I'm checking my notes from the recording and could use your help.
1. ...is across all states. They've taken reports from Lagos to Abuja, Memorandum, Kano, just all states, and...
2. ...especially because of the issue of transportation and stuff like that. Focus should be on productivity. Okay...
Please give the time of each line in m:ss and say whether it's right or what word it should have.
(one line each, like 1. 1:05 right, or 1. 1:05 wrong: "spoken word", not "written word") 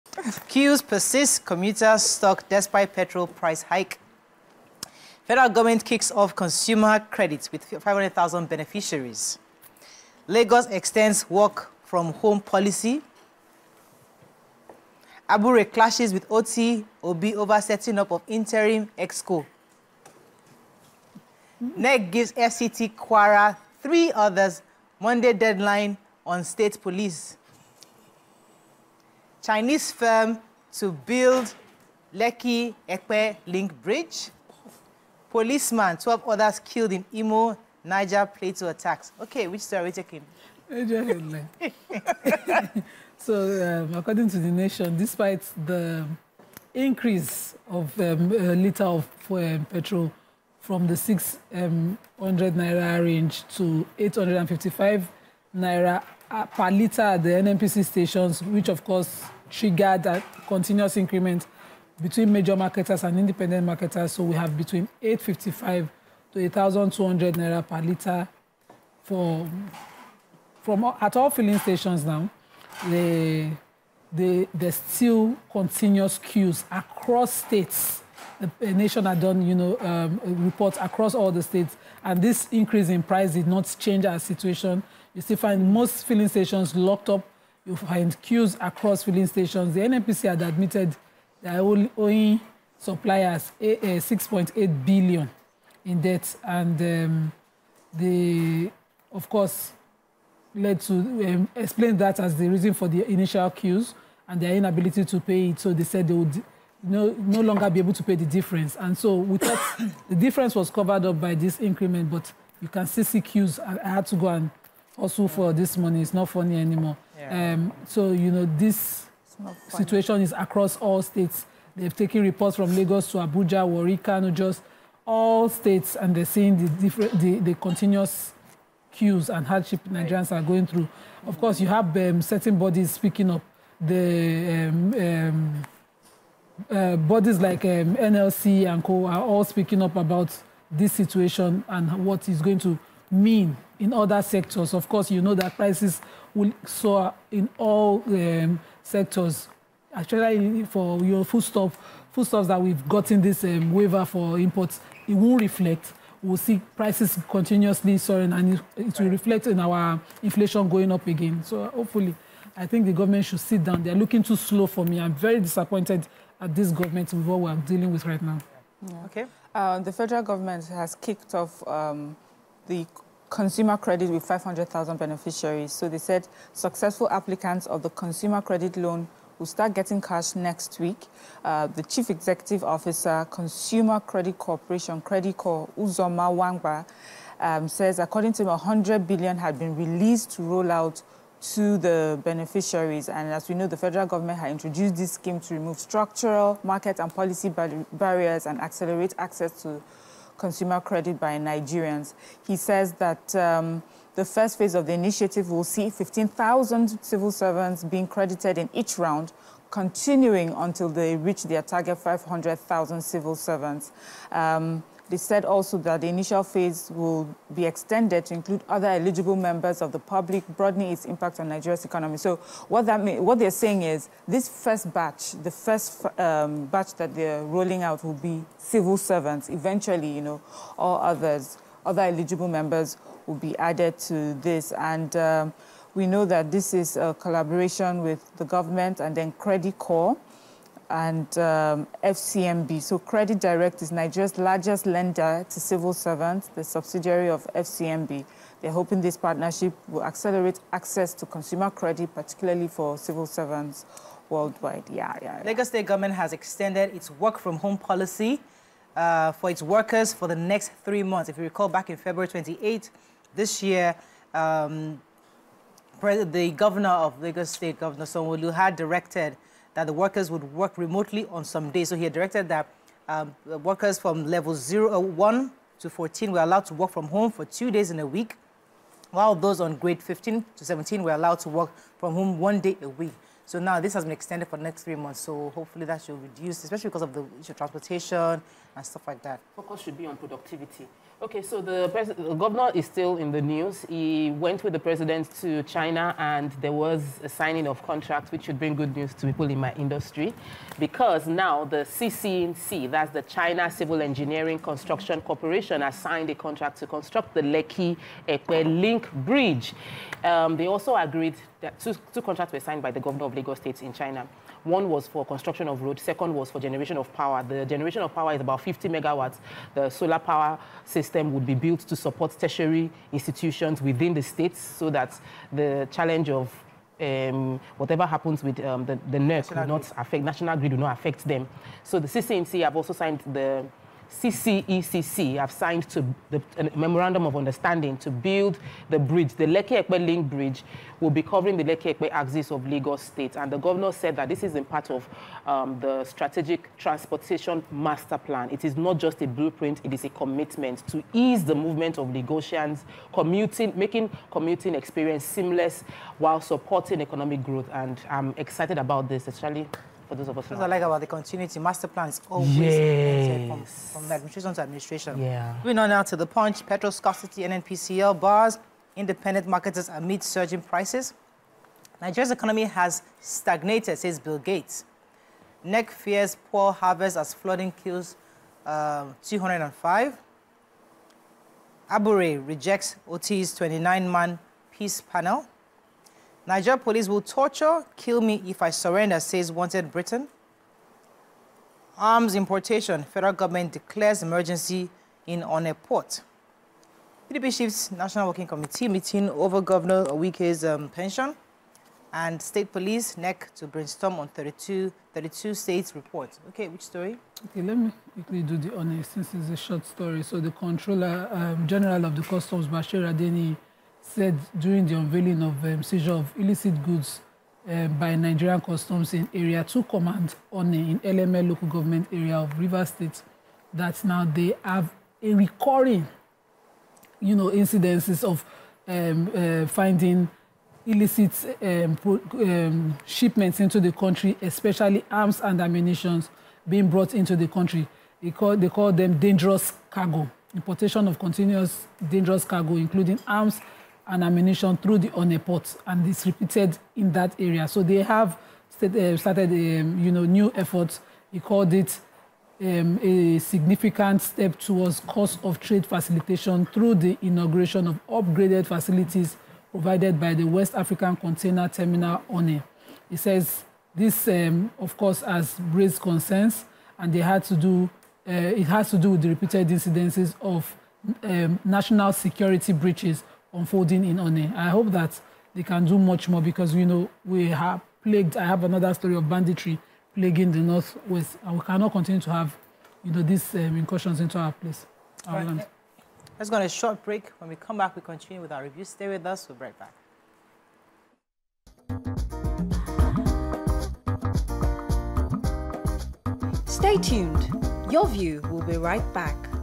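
1. 2:00 wrong: "Warri", not "Memorandum"
2. 4:46 right.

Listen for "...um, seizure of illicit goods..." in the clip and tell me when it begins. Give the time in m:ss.
6:55.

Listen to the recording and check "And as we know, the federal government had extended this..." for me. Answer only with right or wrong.
wrong.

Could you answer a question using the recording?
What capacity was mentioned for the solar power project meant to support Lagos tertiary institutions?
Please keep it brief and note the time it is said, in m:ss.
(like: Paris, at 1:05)
50 megawatts, at 5:18.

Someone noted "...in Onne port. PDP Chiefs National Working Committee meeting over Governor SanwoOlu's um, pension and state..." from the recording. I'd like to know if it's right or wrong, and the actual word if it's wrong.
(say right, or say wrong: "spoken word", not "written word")
wrong: "Owike", not "SanwoOlu".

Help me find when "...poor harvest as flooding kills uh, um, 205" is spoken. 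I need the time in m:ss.
6:16.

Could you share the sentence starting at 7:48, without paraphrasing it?
Uh, it has to do with the repeated incidences of um, national security breaches unfolding in Onne.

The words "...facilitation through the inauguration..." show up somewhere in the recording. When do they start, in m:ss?
7:35.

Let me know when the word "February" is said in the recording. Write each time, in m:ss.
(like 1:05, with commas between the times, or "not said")
4:21.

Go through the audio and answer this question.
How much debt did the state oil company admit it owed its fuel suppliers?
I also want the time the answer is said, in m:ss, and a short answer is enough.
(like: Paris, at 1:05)
6.8 billion, at 1:33.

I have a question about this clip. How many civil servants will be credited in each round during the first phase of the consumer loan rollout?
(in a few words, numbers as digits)
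15,000.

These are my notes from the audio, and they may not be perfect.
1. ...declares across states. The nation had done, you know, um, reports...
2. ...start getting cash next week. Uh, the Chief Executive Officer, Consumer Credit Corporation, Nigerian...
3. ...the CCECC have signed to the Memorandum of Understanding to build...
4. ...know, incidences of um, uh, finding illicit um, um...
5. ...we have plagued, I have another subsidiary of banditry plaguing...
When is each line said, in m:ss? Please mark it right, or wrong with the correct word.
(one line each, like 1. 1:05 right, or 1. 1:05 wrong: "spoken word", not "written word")
1. 1:16 wrong: "queues", not "declares"
2. 2:59 wrong: "CrediCorp", not "Nigerian"
3. 5:33 right
4. 7:07 right
5. 7:57 wrong: "story", not "subsidiary".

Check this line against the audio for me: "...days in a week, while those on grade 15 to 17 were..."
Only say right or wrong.
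right.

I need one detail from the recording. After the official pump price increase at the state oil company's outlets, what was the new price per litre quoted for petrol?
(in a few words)
855 naira.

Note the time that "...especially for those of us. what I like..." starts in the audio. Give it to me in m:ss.
5:59.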